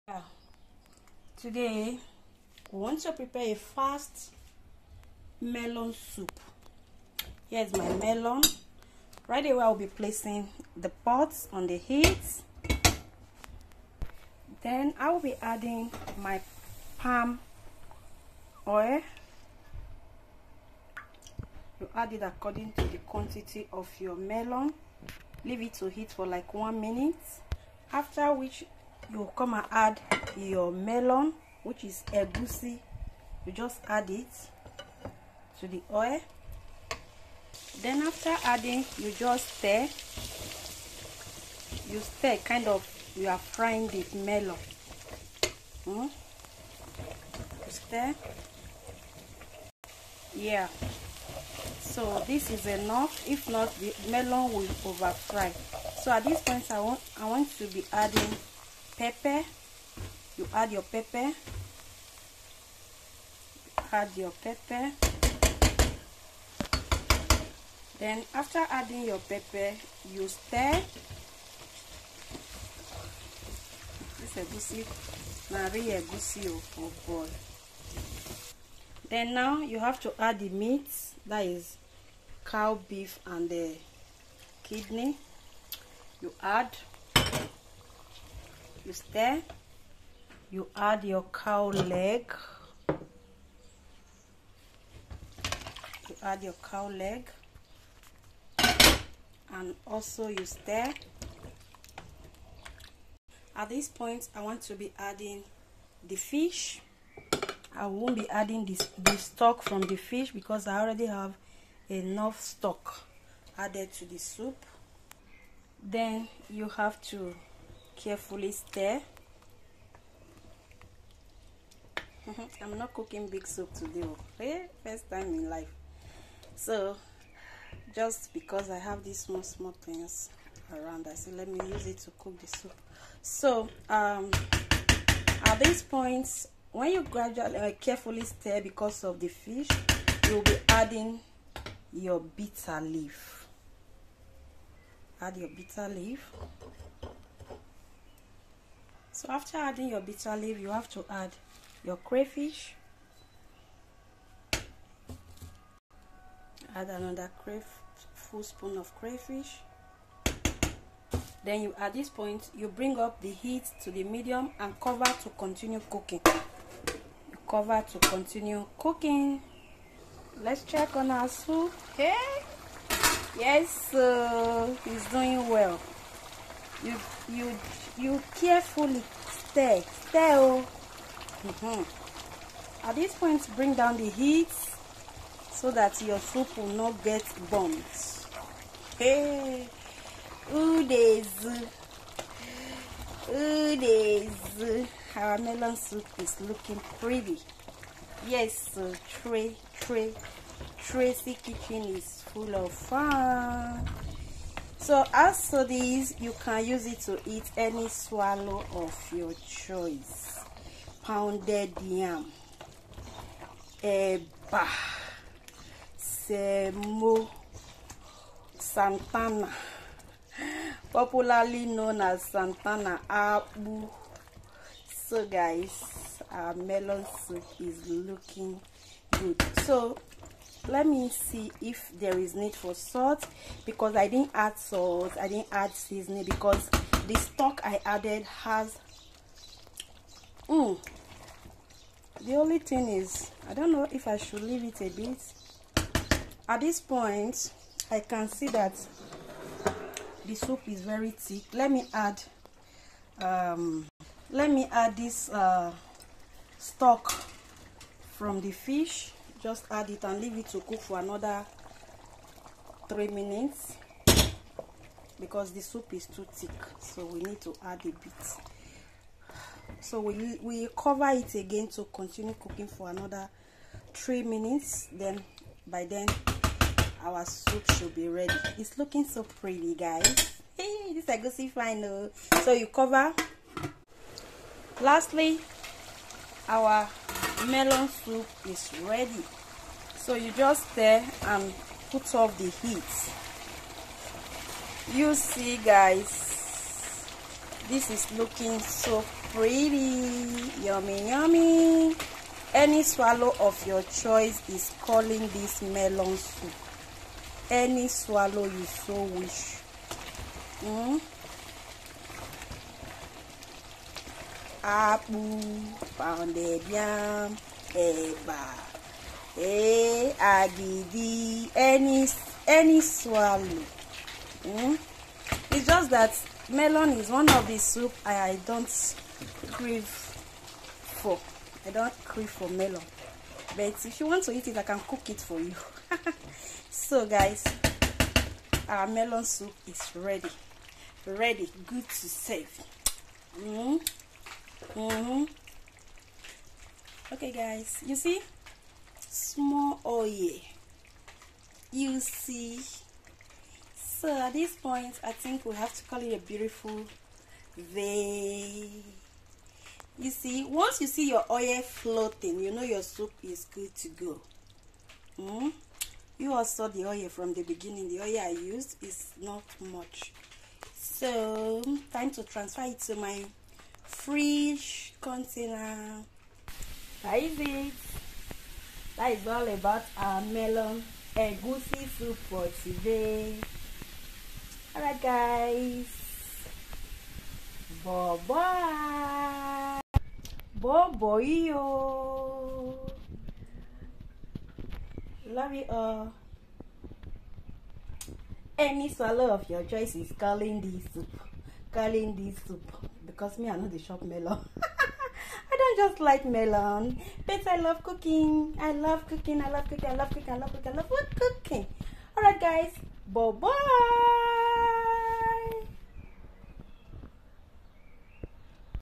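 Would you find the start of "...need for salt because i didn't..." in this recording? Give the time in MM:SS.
03:52.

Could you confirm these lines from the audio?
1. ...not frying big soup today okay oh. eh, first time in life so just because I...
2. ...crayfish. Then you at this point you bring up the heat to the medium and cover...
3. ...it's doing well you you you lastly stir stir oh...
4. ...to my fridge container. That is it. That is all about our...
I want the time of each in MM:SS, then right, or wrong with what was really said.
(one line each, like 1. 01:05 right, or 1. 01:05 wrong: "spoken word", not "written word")
1. 02:02 wrong: "cooking", not "frying"
2. 02:38 right
3. 02:54 wrong: "carefully", not "lastly"
4. 06:12 right.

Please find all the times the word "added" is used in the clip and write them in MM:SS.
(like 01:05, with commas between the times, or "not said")
01:53, 03:57.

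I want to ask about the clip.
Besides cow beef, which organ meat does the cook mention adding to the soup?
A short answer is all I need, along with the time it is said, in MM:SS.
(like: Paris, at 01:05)
kidney, at 01:24.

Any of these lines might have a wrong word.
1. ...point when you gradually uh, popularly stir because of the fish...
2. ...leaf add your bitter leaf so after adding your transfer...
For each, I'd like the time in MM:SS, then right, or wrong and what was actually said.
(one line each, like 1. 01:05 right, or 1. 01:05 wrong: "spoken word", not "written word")
1. 02:15 wrong: "carefully", not "popularly"
2. 02:22 wrong: "bitter", not "transfer".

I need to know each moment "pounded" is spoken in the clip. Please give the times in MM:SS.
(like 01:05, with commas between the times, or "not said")
03:31, 05:15.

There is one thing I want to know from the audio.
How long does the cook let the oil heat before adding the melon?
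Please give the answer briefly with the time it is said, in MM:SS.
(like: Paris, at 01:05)
1 minute, at 00:26.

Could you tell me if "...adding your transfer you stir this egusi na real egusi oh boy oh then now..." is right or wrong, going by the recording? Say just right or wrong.
wrong.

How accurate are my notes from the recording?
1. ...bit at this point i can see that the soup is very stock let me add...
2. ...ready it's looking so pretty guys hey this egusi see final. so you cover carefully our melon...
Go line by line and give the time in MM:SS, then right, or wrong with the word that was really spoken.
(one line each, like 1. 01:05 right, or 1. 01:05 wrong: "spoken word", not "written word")
1. 04:04 wrong: "thick", not "stock"
2. 04:38 wrong: "lastly", not "carefully".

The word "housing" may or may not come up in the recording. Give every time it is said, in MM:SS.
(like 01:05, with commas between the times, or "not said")
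not said.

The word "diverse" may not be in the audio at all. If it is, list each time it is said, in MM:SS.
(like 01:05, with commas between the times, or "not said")
not said.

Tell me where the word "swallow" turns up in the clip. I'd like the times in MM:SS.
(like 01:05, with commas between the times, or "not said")
03:27, 05:02, 05:07, 05:22, 06:38.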